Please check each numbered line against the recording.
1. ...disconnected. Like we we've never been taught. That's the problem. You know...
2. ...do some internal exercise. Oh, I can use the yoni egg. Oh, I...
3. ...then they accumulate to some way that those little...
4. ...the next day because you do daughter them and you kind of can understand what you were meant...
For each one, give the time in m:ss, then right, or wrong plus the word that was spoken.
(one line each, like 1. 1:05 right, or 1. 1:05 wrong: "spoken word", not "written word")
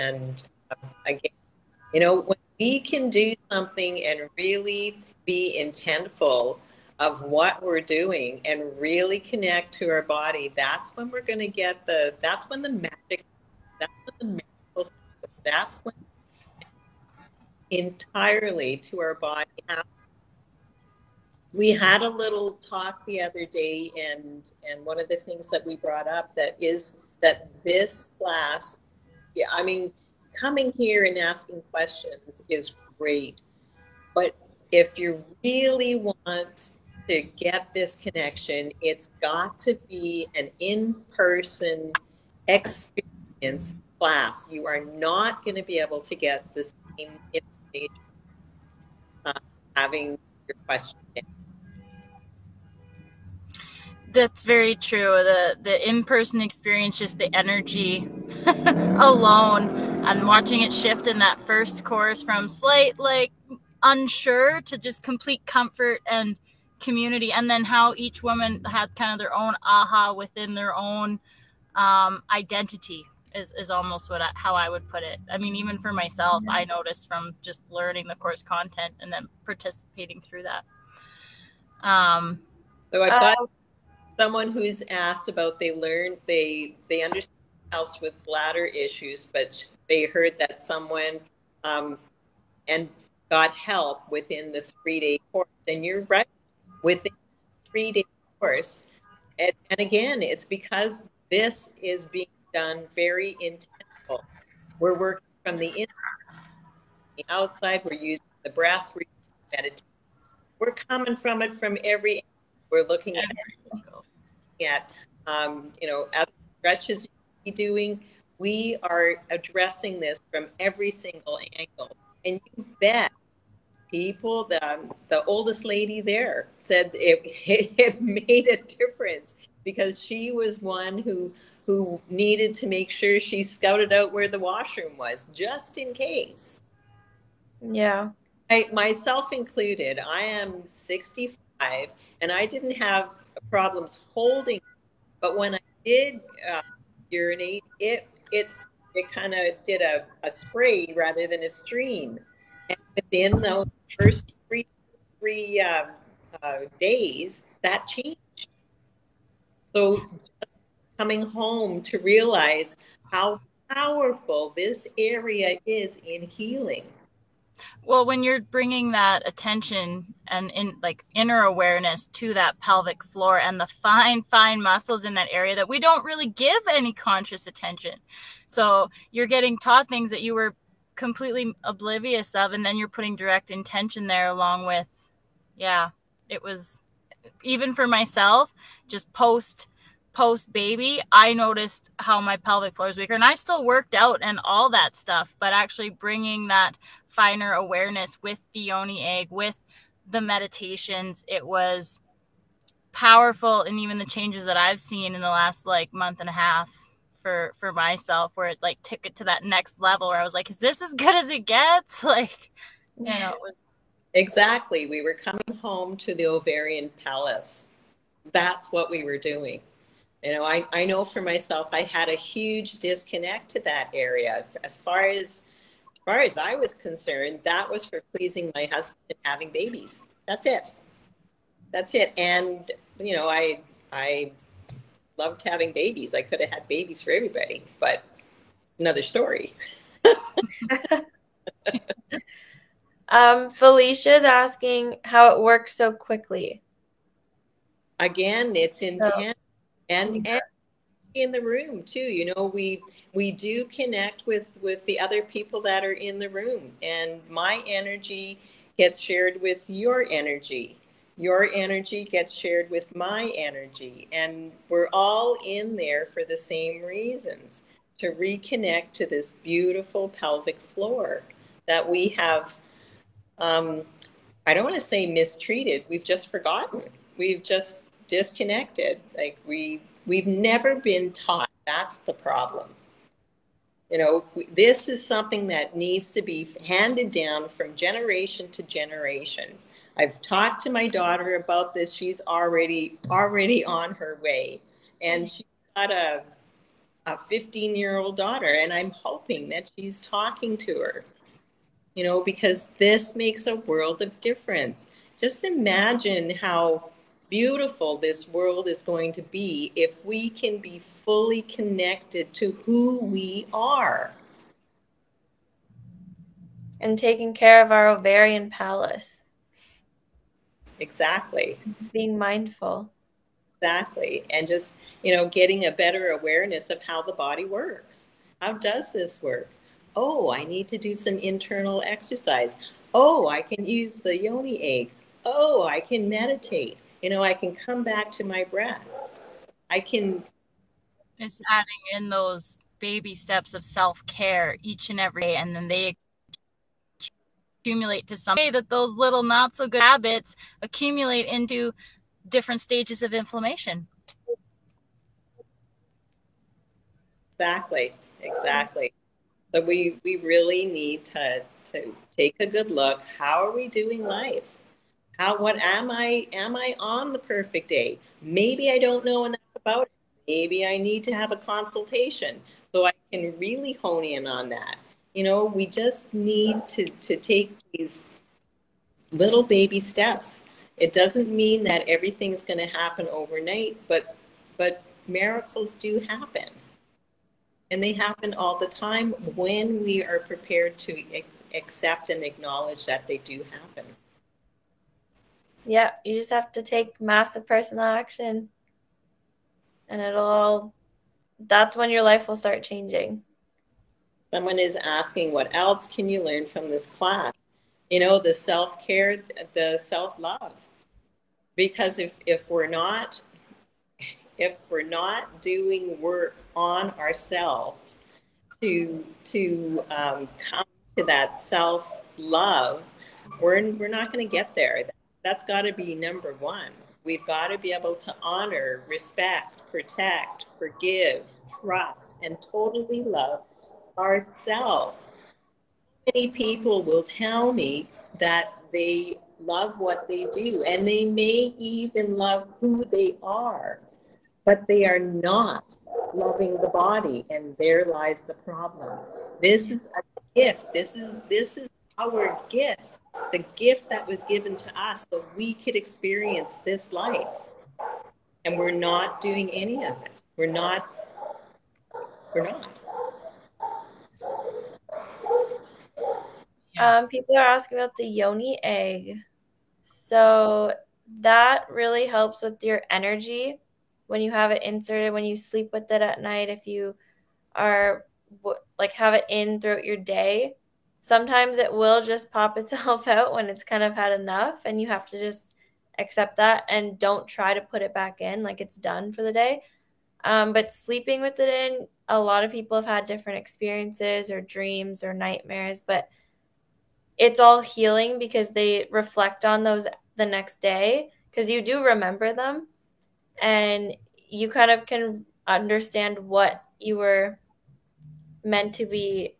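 1. 4:38 right
2. 5:30 right
3. 5:45 right
4. 8:20 wrong: "remember", not "daughter".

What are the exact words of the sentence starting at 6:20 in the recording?
It doesn't mean that everything's going to happen overnight, but but miracles do happen.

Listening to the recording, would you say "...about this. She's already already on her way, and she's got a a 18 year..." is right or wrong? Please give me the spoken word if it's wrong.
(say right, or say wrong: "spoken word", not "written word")
wrong: "15", not "18".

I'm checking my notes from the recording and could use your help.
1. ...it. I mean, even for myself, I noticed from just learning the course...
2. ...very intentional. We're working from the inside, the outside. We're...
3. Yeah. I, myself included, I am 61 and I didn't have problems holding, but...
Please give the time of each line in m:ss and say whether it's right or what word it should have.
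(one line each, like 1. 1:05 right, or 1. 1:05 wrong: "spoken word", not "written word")
1. 1:15 right
2. 1:42 right
3. 2:17 wrong: "65", not "61".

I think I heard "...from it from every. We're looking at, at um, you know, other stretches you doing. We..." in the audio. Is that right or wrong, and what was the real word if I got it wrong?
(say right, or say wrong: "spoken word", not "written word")
right.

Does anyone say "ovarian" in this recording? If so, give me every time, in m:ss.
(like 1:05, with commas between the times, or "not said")
3:36, 5:17.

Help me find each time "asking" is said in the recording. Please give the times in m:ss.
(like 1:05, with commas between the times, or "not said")
0:31, 4:04, 6:44, 7:47.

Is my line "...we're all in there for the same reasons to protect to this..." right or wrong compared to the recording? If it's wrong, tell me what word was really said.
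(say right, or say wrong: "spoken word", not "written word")
wrong: "reconnect", not "protect".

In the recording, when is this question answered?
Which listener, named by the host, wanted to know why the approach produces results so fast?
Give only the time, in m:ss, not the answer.
4:03.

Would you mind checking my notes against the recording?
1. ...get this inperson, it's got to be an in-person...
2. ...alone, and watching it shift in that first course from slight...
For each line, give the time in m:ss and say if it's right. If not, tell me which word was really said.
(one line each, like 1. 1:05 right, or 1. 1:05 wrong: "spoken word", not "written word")
1. 0:37 wrong: "connection", not "inperson"
2. 0:58 right.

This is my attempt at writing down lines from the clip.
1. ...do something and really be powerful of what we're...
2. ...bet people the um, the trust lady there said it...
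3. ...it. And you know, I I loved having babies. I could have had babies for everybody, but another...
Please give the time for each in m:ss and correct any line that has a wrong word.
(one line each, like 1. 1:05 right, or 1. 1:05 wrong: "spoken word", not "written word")
1. 0:03 wrong: "intentful", not "powerful"
2. 2:02 wrong: "oldest", not "trust"
3. 3:51 right.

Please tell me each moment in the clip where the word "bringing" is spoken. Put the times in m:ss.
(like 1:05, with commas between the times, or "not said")
2:48, 3:15.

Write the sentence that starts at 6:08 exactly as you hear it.
Maybe I don't know enough about it.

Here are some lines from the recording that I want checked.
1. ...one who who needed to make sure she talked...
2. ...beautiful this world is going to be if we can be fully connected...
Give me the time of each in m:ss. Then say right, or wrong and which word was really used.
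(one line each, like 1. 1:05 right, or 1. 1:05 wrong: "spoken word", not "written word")
1. 2:10 wrong: "scouted", not "talked"
2. 5:07 right.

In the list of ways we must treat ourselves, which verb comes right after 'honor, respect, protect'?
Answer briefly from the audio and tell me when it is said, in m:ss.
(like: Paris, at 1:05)
Forgive, at 7:10.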